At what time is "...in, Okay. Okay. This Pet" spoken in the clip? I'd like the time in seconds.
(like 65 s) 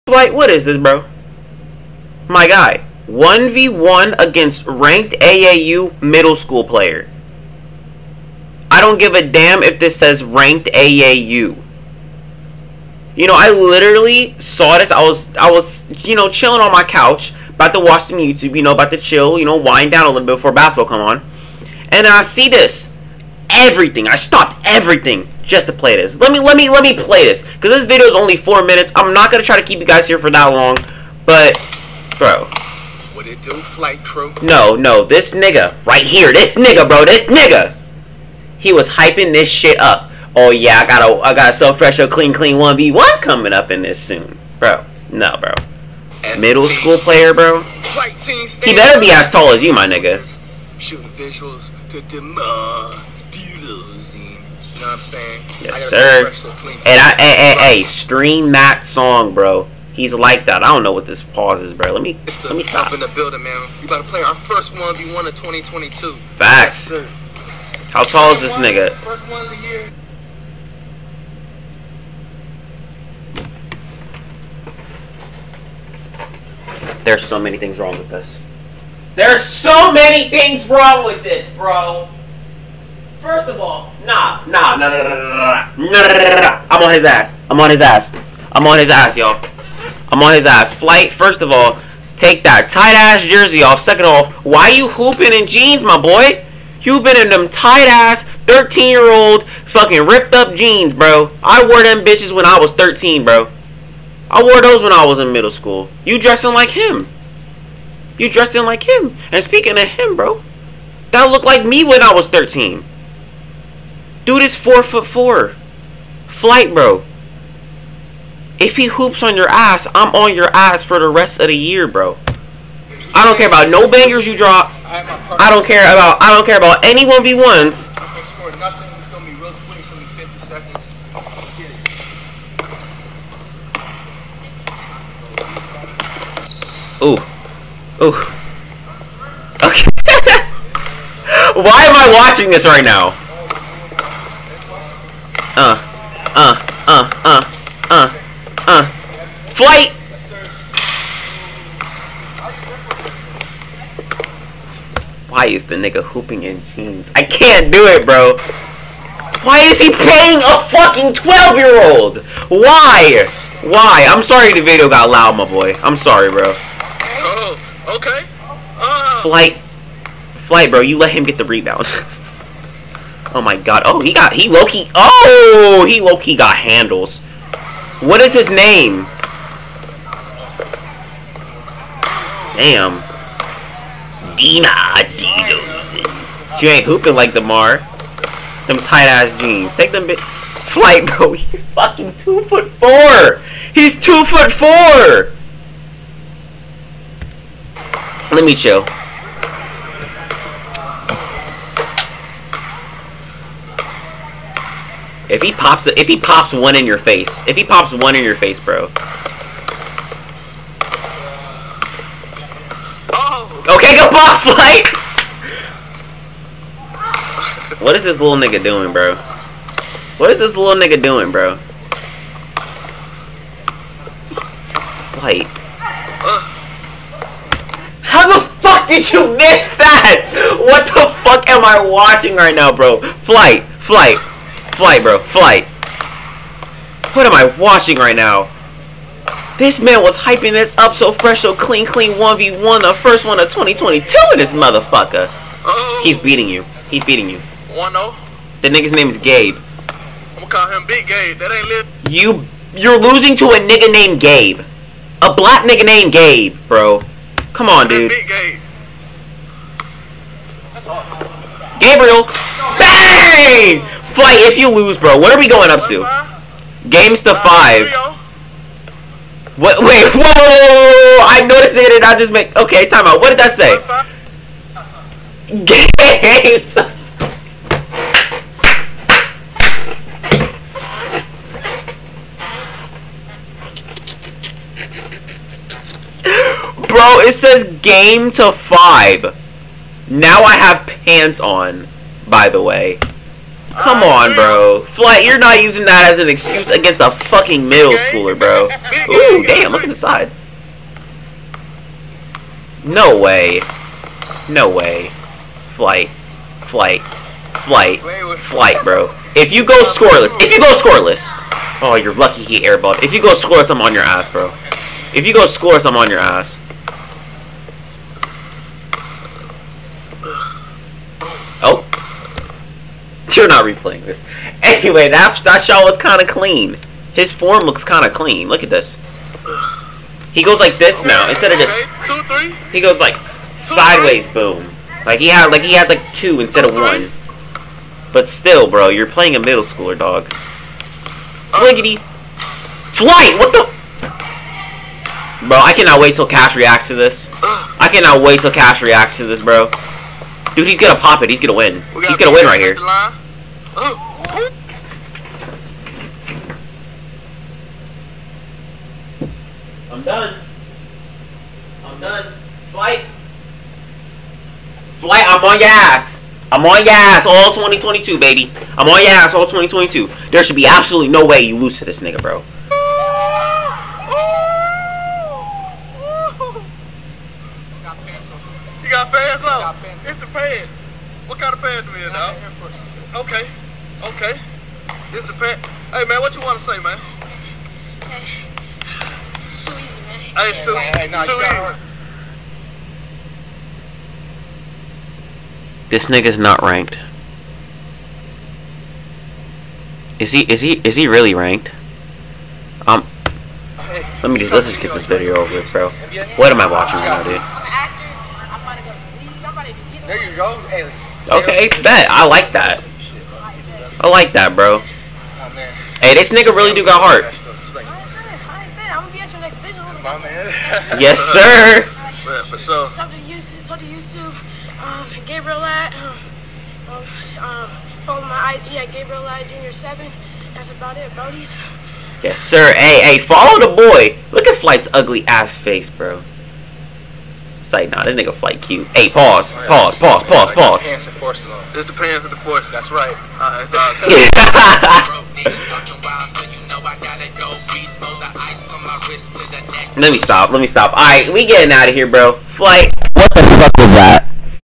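382 s.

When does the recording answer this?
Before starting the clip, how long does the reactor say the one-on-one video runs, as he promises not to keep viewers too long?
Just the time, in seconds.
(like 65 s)
28 s.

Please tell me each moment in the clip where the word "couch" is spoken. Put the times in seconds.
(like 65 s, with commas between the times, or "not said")
16 s.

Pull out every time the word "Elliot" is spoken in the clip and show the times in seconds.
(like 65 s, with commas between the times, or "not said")
not said.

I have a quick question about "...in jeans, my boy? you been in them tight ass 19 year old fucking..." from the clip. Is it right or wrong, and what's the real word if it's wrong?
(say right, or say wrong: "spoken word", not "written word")
wrong: "13", not "19".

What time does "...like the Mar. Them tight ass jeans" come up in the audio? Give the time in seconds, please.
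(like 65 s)
187 s.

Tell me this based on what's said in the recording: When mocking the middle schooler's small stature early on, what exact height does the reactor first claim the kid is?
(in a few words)
4 foot 4.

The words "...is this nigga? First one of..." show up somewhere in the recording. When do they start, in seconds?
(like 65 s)
68 s.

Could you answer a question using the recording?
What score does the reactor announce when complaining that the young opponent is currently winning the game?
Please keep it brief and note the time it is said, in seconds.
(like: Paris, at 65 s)
1-0, at 247 s.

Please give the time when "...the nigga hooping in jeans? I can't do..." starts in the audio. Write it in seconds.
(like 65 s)
155 s.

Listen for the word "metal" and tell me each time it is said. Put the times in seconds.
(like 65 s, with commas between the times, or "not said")
not said.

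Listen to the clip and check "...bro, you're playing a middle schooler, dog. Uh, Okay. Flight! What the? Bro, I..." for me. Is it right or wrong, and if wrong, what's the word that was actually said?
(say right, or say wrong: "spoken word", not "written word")
wrong: "Fliggity", not "Okay".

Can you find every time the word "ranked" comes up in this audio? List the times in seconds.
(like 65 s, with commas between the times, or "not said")
4 s, 10 s, 396 s, 401 s.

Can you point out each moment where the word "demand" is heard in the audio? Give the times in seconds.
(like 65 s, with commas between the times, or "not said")
52 s.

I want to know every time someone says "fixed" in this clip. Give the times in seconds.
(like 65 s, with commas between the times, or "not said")
not said.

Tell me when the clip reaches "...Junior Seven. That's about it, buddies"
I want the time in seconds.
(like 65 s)
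429 s.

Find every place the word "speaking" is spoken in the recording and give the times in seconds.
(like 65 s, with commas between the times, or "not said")
109 s.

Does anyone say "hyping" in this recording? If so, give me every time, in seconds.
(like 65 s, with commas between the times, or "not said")
38 s, 240 s.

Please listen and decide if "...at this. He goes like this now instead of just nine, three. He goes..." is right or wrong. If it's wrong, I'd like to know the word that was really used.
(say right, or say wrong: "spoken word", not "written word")
wrong: "two", not "nine".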